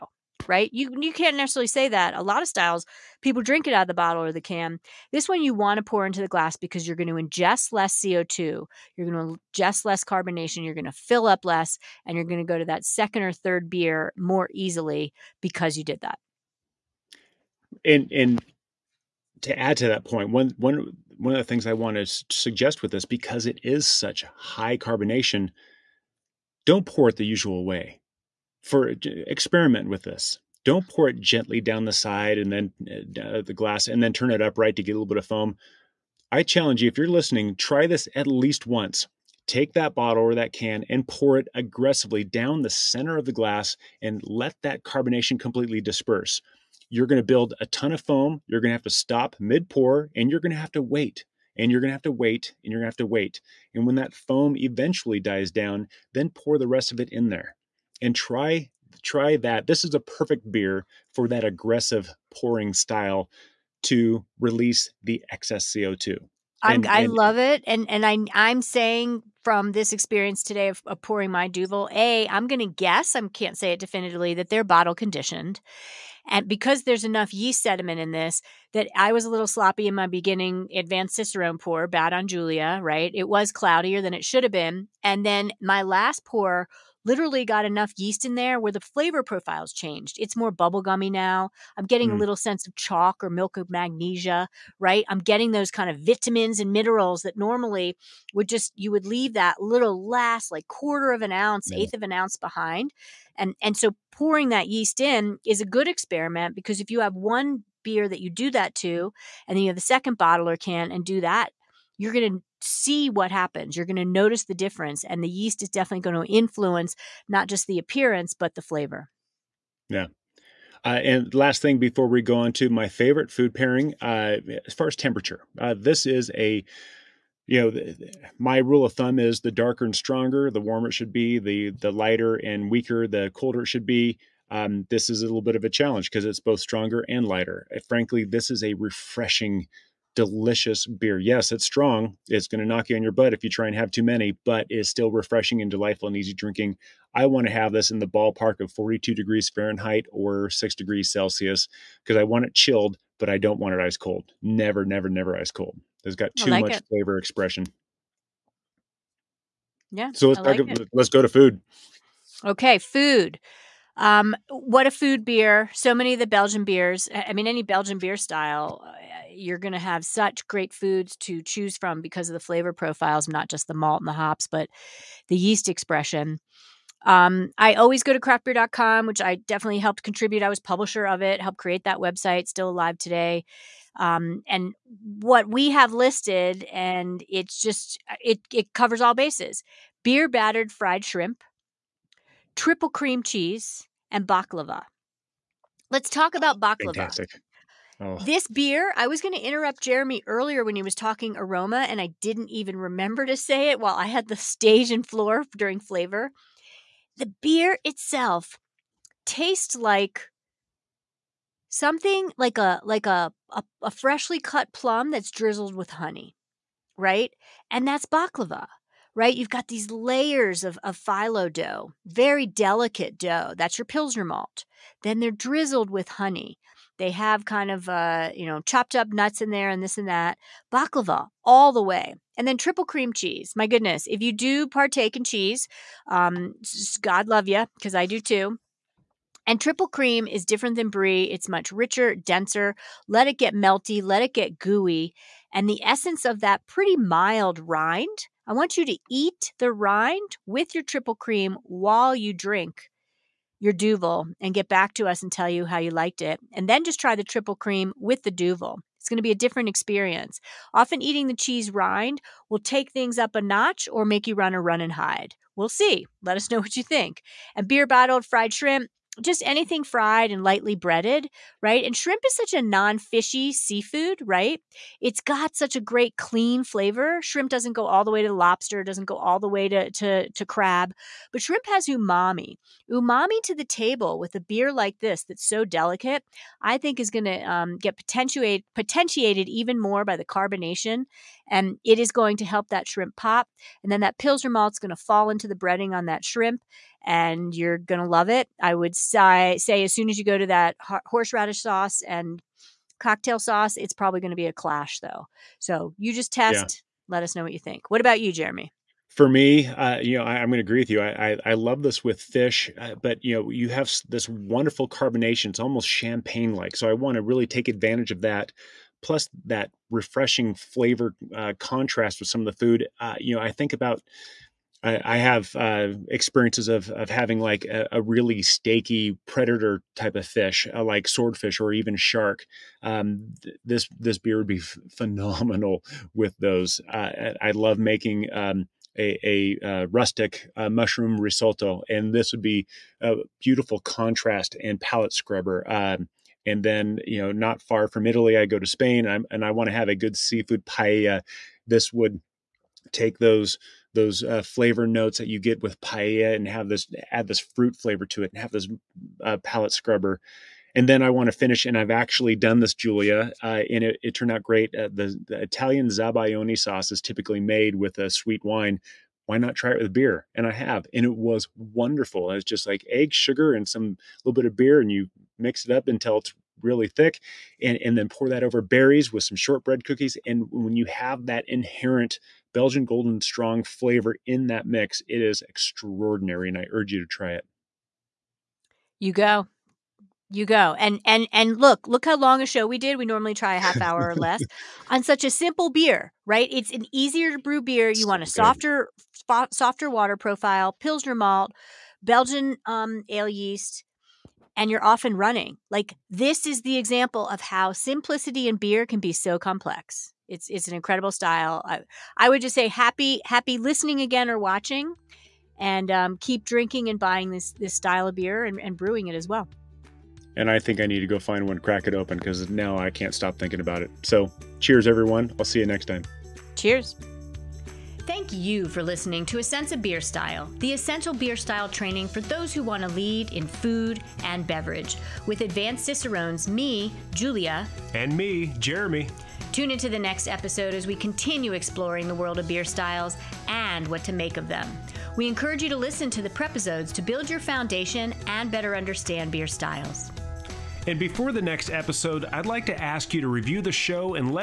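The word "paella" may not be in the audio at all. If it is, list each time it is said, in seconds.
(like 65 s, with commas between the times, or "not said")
350 s, 355 s.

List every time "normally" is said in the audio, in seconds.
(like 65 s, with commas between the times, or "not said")
97 s, 393 s.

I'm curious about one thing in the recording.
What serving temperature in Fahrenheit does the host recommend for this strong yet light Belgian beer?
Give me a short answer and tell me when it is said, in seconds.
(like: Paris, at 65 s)
42 degrees Fahrenheit, at 148 s.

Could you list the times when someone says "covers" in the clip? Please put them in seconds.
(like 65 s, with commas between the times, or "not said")
188 s.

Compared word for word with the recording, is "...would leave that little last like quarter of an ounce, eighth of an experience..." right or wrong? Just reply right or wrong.
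wrong.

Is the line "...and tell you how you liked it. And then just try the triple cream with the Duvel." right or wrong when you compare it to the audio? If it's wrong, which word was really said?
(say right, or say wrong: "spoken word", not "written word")
right.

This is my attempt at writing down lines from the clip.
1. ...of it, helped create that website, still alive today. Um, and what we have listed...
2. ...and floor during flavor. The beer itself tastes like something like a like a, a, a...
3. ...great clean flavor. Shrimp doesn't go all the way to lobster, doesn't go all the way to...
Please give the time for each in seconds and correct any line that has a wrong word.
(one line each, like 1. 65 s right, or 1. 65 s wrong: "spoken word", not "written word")
1. 181 s right
2. 204 s right
3. 275 s right.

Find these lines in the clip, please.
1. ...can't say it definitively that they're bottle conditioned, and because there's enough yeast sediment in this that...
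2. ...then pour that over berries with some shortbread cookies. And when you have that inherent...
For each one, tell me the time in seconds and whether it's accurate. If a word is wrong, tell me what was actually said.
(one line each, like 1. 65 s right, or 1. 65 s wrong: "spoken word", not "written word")
1. 73 s right
2. 377 s right.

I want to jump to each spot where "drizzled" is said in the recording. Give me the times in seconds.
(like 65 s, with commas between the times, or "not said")
215 s, 225 s.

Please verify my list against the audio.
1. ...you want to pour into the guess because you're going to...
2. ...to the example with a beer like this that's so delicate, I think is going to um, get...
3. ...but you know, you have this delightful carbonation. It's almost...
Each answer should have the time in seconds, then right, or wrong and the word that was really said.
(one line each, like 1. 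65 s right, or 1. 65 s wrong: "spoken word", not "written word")
1. 5 s wrong: "glass", not "guess"
2. 283 s wrong: "table", not "example"
3. 313 s wrong: "wonderful", not "delightful".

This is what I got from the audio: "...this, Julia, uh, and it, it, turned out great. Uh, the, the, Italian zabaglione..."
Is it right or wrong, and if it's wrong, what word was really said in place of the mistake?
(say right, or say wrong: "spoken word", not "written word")
right.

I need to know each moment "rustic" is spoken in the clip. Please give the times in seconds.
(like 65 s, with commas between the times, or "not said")
339 s.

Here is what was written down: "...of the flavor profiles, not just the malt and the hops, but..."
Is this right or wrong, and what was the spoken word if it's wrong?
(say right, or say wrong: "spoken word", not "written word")
right.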